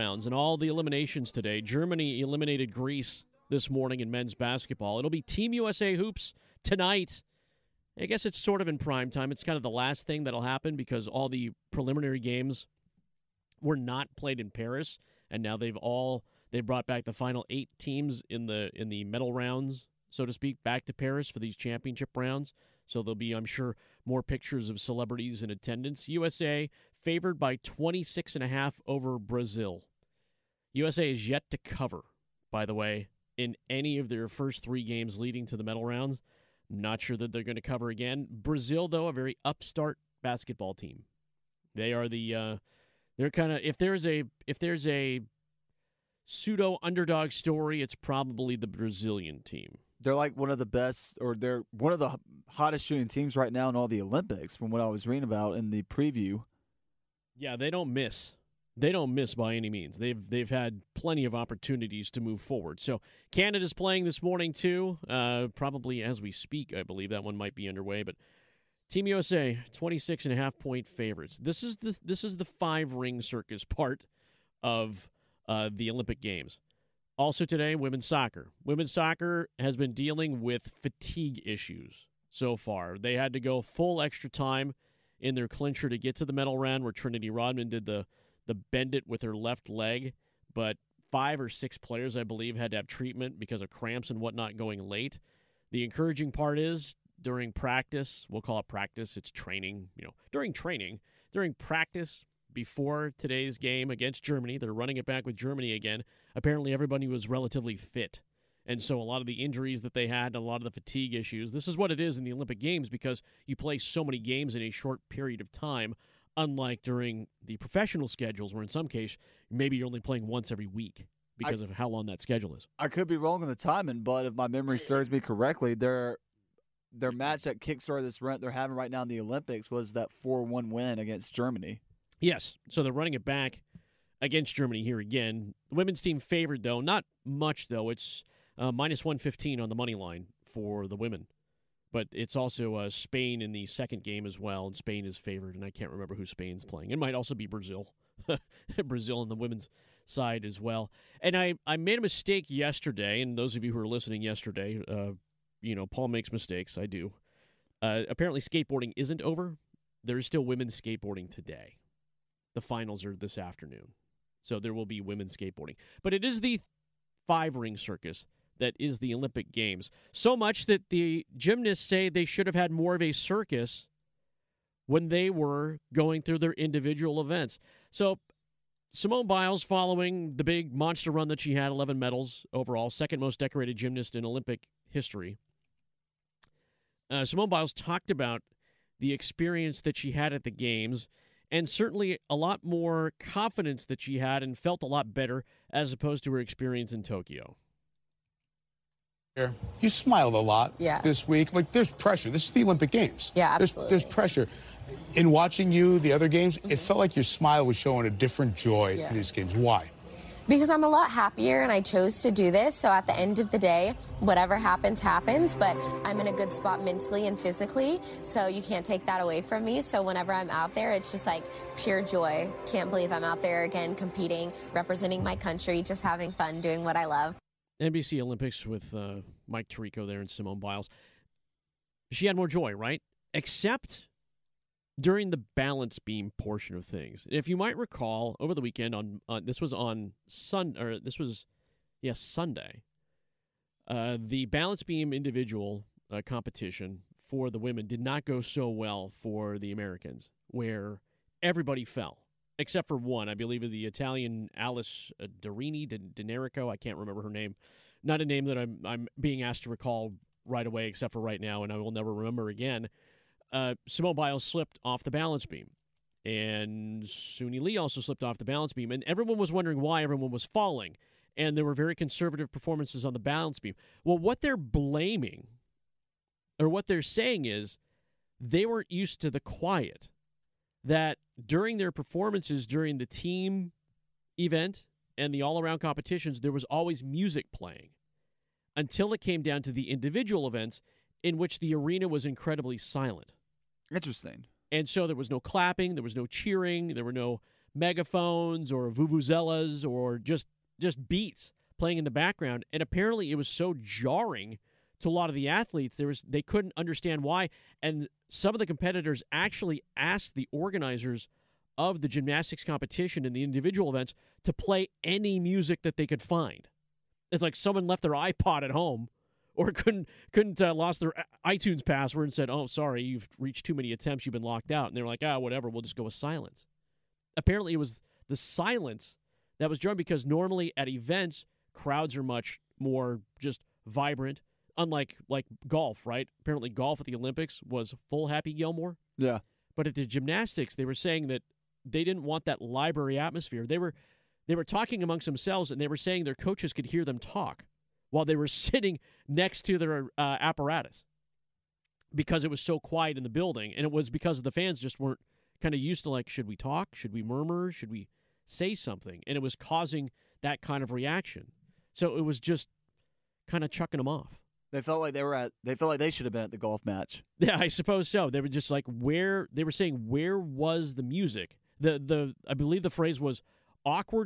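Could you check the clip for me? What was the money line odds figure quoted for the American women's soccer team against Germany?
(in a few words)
-115.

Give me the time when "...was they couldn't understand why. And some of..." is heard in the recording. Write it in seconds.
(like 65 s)
306 s.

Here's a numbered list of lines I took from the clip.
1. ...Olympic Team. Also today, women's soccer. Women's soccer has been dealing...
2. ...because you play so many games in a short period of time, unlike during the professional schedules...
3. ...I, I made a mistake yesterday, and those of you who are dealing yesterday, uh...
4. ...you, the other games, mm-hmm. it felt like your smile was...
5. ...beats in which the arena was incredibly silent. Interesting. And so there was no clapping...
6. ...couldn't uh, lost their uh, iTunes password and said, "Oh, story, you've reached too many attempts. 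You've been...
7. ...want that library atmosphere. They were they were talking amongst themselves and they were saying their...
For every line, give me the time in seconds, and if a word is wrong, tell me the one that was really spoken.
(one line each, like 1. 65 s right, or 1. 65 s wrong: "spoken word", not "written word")
1. 75 s wrong: "Games", not "Team"
2. 112 s right
3. 151 s wrong: "listening", not "dealing"
4. 205 s right
5. 290 s wrong: "events", not "beats"
6. 320 s wrong: "sorry", not "story"
7. 342 s right.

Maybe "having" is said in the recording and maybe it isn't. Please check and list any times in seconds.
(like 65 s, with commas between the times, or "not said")
128 s, 226 s.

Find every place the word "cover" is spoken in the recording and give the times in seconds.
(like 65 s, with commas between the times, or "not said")
31 s, 37 s.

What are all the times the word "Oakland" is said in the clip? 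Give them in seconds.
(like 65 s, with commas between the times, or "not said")
not said.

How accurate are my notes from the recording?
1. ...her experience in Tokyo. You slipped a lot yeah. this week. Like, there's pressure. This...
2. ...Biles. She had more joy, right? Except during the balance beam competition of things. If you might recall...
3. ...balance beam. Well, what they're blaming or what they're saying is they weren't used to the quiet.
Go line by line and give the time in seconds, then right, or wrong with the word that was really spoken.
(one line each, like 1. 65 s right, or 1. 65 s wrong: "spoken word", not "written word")
1. 196 s wrong: "smiled", not "slipped"
2. 230 s wrong: "portion", not "competition"
3. 273 s right.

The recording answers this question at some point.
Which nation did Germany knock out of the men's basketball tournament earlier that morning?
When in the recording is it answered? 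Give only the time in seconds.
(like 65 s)
1 s.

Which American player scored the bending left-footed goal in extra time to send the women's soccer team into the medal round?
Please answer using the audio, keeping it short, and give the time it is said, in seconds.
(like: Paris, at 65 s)
Trinity Rodman, at 86 s.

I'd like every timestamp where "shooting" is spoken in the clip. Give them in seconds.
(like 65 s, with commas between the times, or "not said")
52 s.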